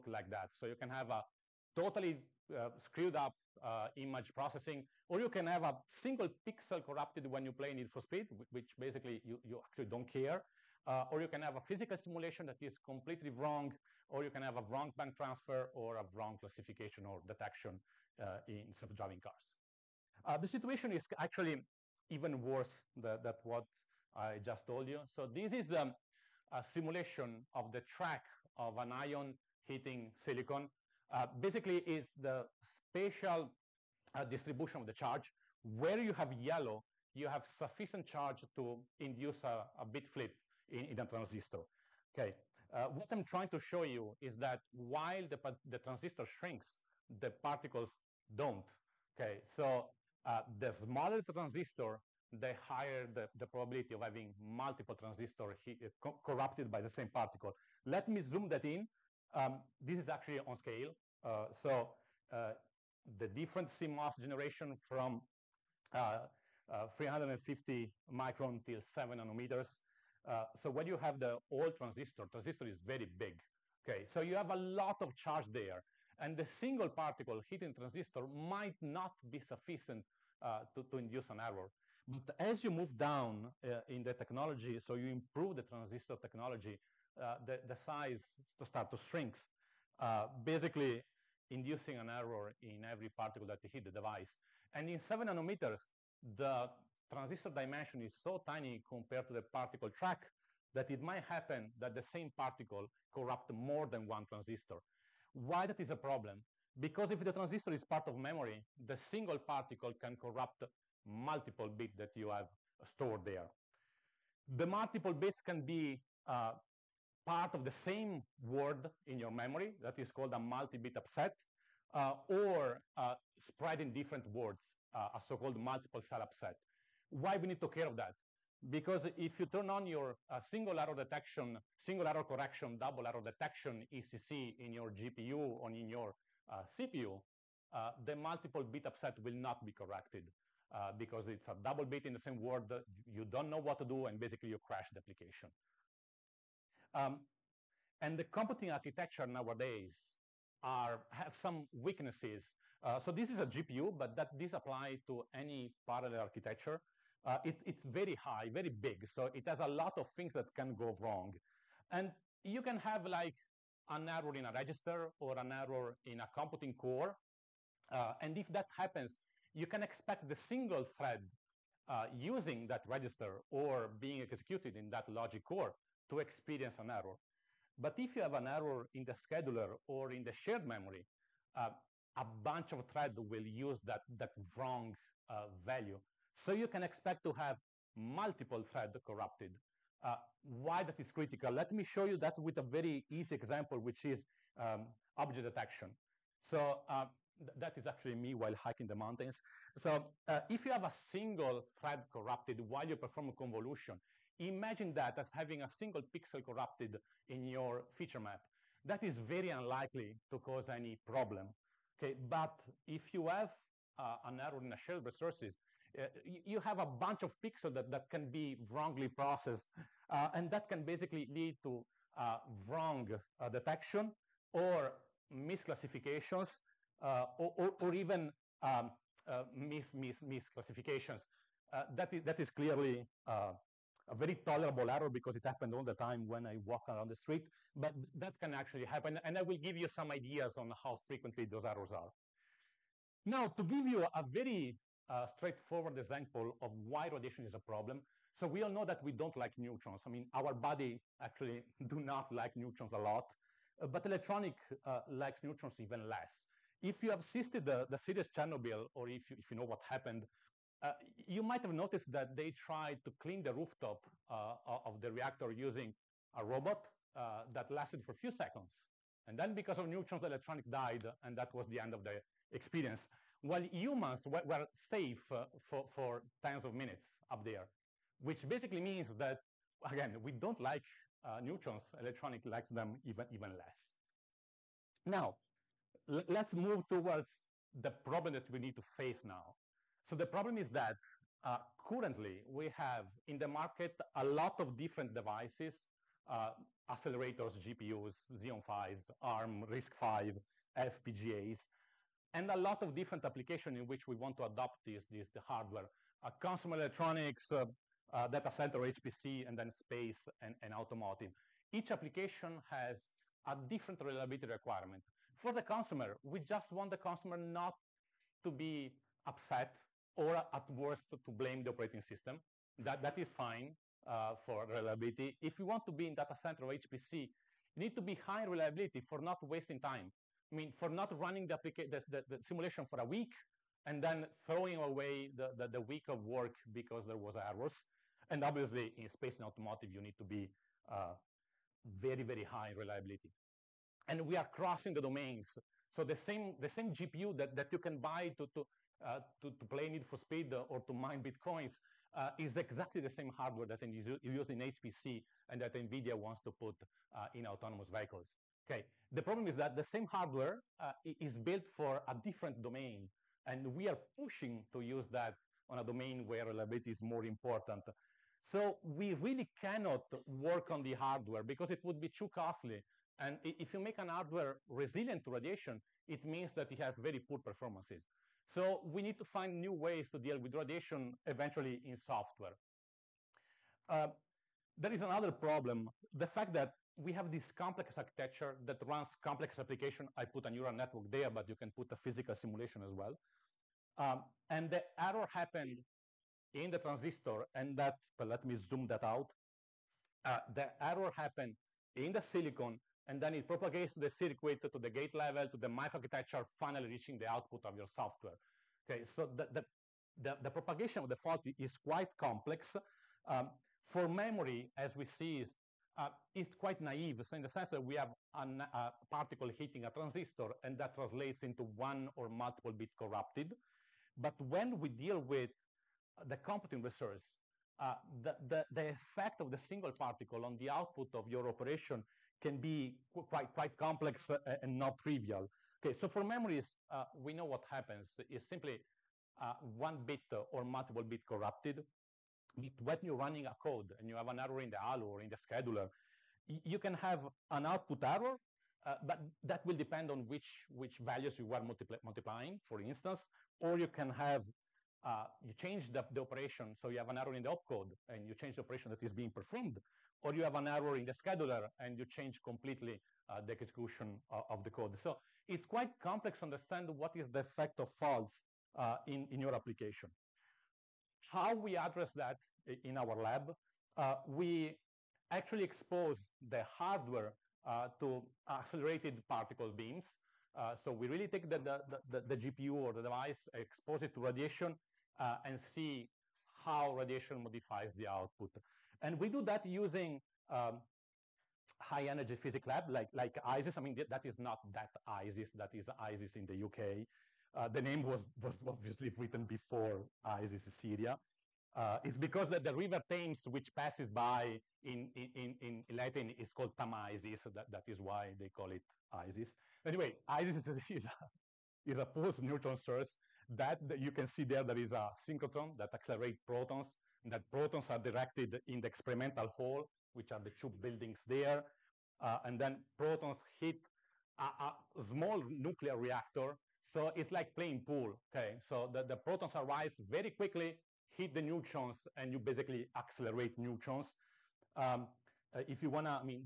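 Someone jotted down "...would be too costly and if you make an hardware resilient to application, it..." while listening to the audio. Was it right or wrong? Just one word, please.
wrong.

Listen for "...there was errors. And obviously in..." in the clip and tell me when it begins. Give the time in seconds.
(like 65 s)
337 s.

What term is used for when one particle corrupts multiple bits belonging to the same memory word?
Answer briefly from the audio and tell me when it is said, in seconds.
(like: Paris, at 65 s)
multi-bit upset, at 120 s.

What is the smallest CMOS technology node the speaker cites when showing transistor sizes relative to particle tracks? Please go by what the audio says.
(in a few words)
7 nanometers.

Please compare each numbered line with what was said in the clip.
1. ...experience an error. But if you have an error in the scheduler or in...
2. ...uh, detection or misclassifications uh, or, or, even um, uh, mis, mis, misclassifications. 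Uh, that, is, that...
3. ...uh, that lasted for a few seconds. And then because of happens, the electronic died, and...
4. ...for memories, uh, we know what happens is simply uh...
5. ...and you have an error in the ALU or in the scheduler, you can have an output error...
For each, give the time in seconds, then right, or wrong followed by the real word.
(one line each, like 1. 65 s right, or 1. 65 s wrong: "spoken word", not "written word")
1. 176 s right
2. 223 s right
3. 267 s wrong: "neutrons", not "happens"
4. 436 s right
5. 443 s right.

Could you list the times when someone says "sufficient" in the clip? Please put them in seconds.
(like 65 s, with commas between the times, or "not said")
37 s, 79 s.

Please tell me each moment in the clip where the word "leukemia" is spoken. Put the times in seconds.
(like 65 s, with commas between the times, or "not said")
not said.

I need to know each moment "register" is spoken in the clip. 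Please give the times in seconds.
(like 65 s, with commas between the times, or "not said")
164 s, 172 s.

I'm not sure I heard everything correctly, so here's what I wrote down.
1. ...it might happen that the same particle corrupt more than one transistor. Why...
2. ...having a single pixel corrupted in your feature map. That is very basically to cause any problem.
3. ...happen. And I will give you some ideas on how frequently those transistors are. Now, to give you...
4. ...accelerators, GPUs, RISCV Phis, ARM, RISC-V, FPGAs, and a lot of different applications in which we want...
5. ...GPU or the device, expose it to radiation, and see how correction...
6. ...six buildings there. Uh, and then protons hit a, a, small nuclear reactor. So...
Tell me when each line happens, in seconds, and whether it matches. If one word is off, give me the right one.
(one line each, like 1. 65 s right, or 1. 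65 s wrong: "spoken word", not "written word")
1. 100 s right
2. 205 s wrong: "unlikely", not "basically"
3. 238 s wrong: "errors", not "transistors"
4. 296 s wrong: "Xeon", not "RISCV"
5. 482 s wrong: "radiation", not "correction"
6. 520 s wrong: "two", not "six".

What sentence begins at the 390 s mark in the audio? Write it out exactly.
I put a neural network there, but you can put a physical simulation as well.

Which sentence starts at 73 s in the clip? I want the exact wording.
Okay, so you have a lot of charge there.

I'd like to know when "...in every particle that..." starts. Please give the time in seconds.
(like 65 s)
92 s.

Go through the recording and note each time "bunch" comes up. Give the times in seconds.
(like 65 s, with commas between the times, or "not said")
182 s, 216 s.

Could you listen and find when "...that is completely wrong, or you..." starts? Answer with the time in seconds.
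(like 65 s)
12 s.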